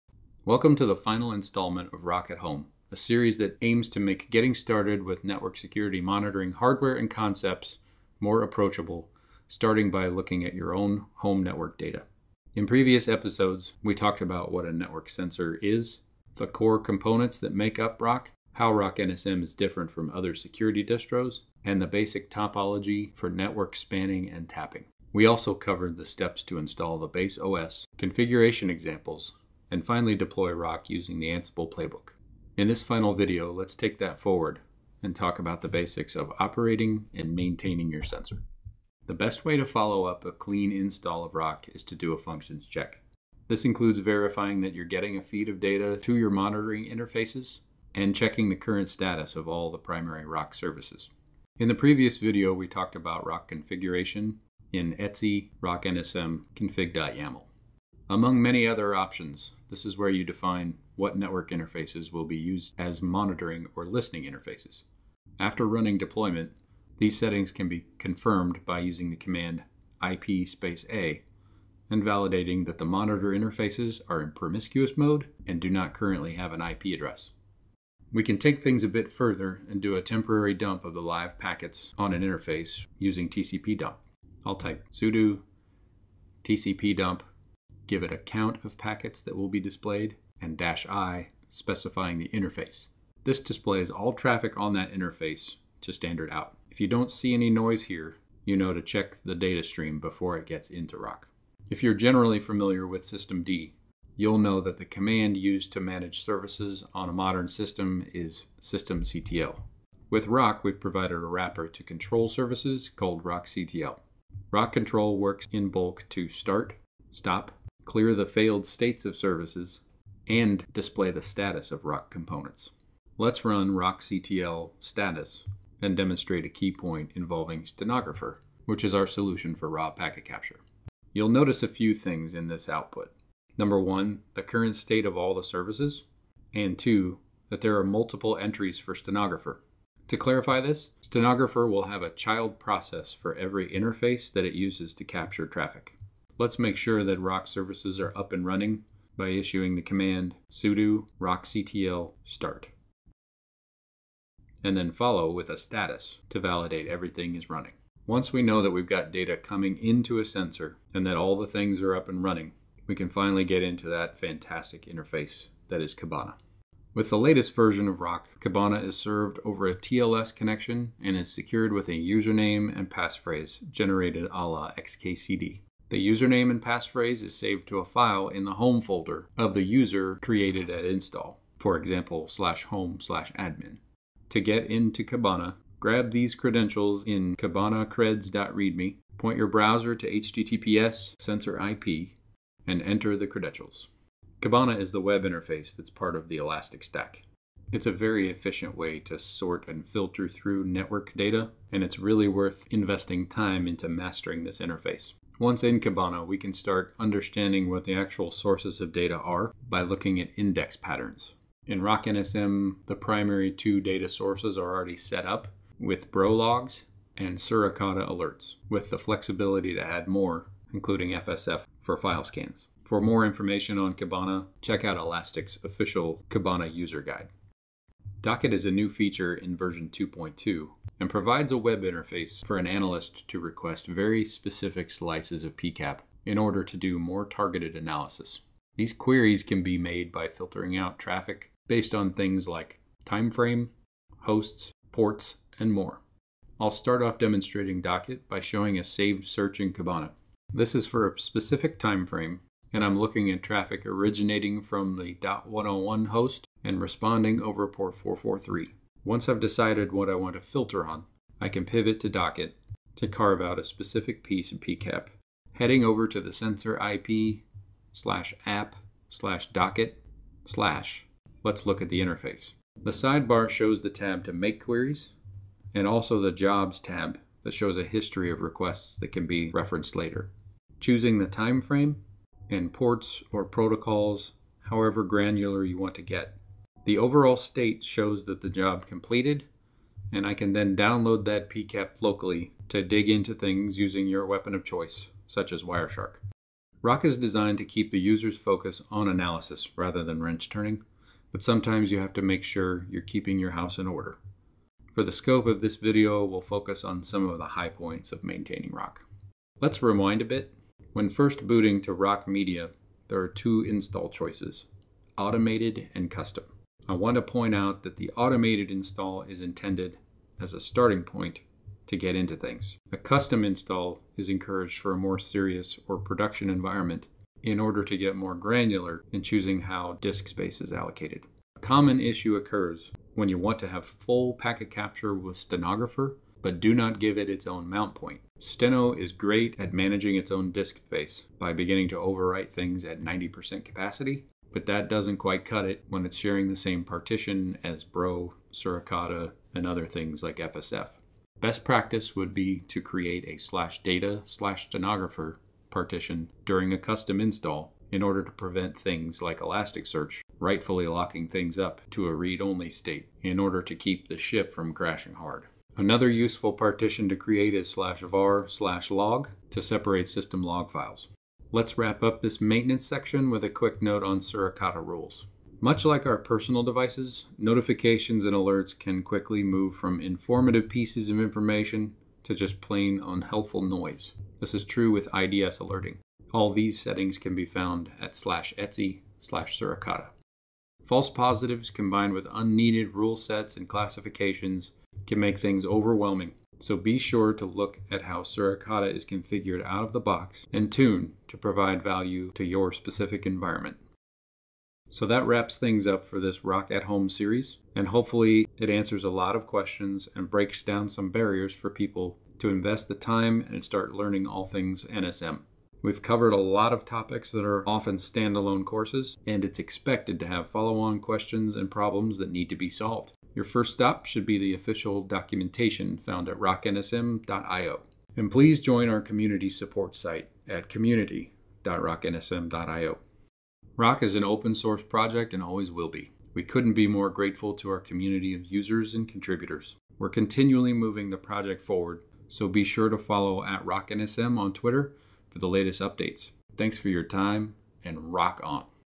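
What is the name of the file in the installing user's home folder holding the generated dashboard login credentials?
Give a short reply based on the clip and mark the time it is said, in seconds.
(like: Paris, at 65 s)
kibanacreds.readme, at 187 s.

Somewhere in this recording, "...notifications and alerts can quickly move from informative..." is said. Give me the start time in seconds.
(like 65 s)
377 s.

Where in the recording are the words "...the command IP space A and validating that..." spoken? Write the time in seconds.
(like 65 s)
69 s.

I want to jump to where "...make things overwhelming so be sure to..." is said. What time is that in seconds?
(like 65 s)
395 s.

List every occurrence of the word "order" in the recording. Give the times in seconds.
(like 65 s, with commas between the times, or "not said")
236 s, 303 s, 327 s, 358 s, 363 s.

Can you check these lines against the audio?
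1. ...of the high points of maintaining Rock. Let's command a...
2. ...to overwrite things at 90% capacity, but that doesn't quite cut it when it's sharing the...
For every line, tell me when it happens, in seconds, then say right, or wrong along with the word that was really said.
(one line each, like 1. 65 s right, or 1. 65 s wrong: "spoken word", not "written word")
1. 307 s wrong: "rewind", not "command"
2. 341 s right.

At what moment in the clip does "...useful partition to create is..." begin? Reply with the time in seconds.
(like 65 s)
366 s.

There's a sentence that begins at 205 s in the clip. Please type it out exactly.
Once in Kibana, we can start understanding what the actual sources of data are by looking at index patterns.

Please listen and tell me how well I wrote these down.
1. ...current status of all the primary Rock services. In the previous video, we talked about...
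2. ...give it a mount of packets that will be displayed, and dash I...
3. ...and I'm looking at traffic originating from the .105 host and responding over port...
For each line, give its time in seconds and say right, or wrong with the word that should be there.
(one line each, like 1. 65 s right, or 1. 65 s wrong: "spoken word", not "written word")
1. 48 s right
2. 87 s wrong: "count", not "mount"
3. 252 s wrong: "101", not "105".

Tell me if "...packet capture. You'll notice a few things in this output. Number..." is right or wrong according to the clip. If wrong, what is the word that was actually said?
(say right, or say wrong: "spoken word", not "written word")
right.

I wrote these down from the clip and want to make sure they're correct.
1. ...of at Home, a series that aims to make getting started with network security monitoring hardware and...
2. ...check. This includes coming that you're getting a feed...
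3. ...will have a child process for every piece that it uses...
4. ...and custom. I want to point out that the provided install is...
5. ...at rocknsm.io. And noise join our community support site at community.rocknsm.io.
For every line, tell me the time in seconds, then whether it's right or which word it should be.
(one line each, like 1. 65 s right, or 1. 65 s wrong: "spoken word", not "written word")
1. 1 s right
2. 42 s wrong: "verifying", not "coming"
3. 141 s wrong: "interface", not "piece"
4. 315 s wrong: "automated", not "provided"
5. 426 s wrong: "please", not "noise".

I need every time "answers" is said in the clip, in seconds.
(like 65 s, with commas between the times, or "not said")
408 s.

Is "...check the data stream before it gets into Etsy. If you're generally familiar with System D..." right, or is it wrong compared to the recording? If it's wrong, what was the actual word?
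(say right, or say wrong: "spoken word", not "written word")
wrong: "Rock", not "Etsy".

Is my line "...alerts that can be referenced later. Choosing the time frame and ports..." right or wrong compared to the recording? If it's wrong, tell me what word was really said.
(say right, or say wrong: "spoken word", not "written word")
wrong: "requests", not "alerts".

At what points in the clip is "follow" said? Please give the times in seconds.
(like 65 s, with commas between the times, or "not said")
39 s, 154 s, 420 s, 442 s.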